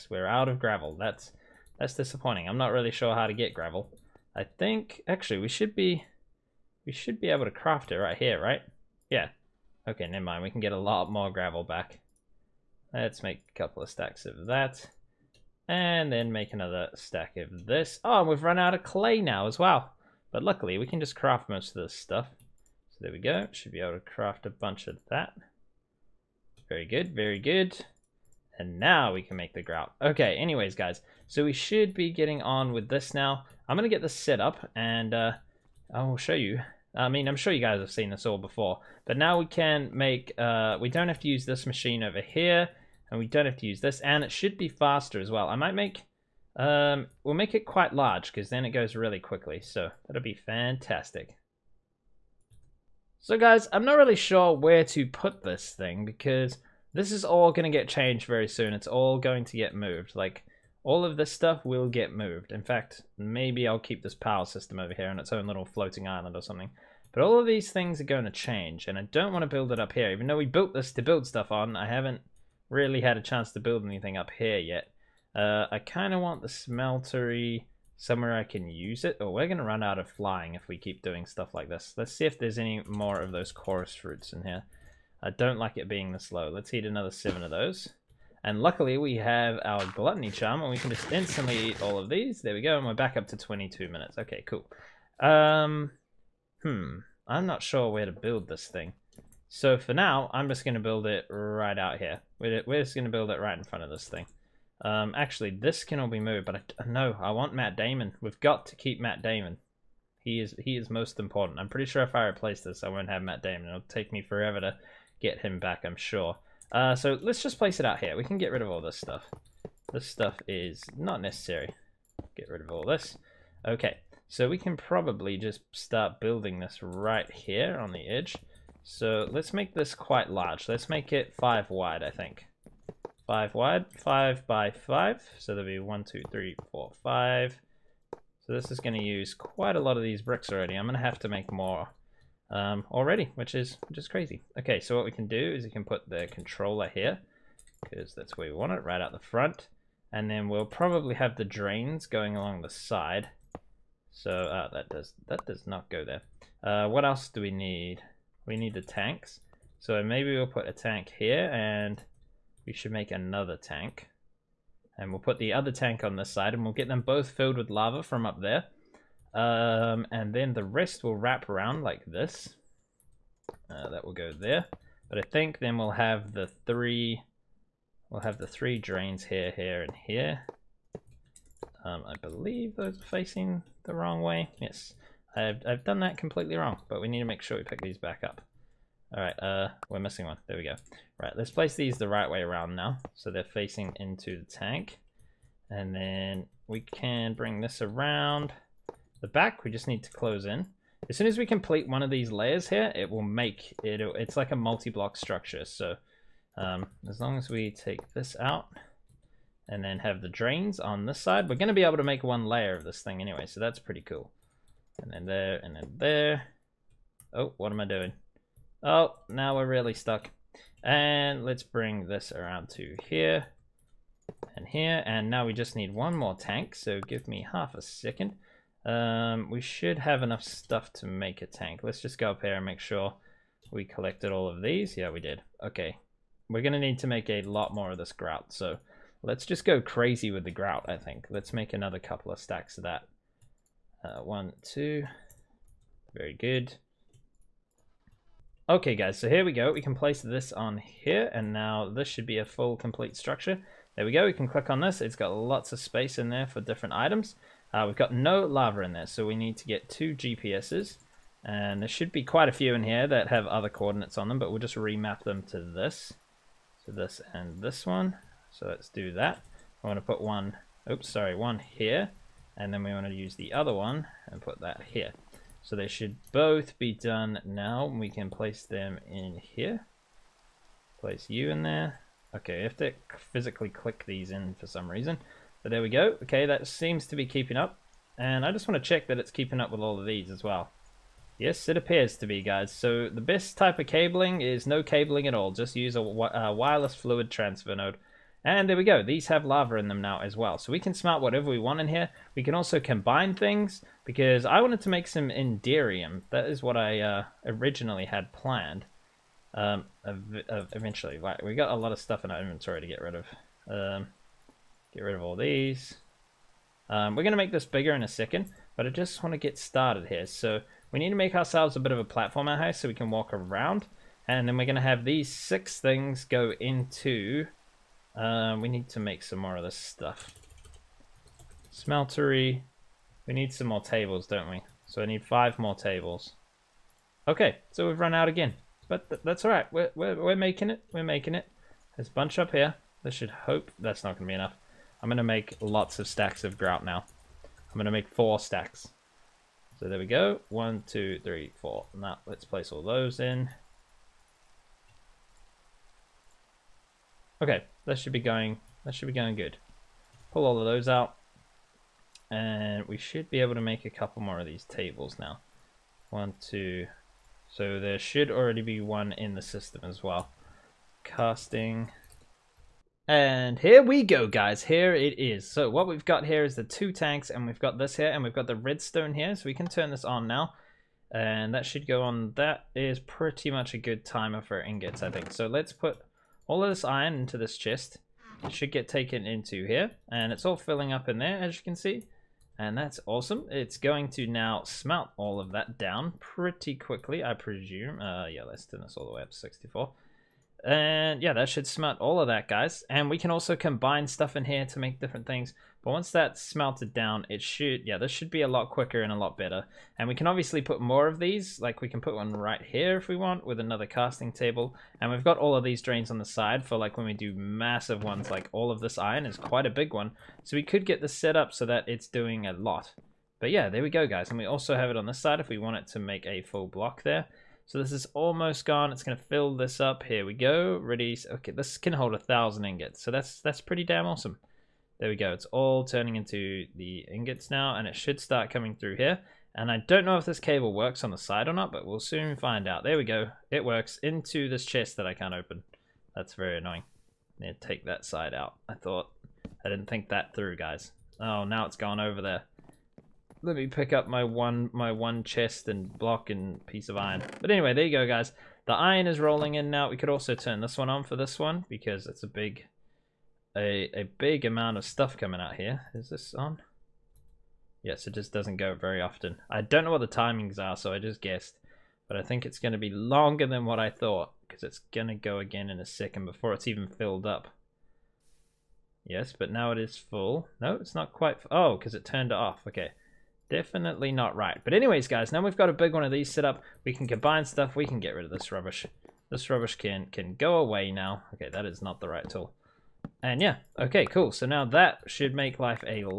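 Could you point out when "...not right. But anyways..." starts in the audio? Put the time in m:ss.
8:04.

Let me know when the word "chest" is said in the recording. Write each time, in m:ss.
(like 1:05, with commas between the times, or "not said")
6:27, 7:24, 7:35.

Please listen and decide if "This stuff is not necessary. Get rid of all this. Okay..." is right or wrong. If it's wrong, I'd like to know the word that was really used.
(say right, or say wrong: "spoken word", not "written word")
right.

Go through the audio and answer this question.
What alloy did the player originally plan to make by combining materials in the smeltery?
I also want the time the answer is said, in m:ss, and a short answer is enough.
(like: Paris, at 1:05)
Enderium, at 5:05.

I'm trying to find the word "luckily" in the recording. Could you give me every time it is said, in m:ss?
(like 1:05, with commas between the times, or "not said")
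0:20, 1:28.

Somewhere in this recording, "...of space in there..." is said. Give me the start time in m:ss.
4:15.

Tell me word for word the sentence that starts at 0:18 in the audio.
Oh, and we've run out of clay now as well.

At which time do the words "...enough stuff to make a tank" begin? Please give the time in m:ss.
3:50.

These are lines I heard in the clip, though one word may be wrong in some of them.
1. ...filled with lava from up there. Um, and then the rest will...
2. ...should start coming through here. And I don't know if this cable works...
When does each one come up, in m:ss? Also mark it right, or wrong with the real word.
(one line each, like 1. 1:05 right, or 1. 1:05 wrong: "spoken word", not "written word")
1. 2:47 right
2. 7:17 right.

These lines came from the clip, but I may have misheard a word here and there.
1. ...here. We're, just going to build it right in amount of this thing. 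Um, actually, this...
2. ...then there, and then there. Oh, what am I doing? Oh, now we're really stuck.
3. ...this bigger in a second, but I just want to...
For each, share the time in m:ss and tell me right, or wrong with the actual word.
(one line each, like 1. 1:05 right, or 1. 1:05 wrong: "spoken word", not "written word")
1. 1:41 wrong: "front", not "amount"
2. 3:35 right
3. 5:17 right.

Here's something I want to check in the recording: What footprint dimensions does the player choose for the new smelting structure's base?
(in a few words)
5 by 5.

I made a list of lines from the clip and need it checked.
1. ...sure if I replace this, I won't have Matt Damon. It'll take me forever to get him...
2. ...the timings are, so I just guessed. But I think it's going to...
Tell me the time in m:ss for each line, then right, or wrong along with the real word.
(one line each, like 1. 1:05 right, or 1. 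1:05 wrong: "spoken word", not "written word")
1. 1:51 right
2. 7:50 right.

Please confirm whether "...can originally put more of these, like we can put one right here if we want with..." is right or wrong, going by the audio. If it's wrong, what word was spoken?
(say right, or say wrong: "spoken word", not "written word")
wrong: "obviously", not "originally".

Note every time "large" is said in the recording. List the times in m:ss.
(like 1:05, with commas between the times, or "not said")
0:47, 2:10.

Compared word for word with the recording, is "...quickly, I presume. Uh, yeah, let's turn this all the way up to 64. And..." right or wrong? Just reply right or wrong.
right.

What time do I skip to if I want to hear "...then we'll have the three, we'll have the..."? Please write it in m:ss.
2:55.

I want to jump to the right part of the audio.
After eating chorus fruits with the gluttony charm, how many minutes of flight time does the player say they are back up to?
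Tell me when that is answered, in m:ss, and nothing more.
1:33.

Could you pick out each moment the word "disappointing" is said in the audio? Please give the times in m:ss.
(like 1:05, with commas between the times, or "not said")
0:01.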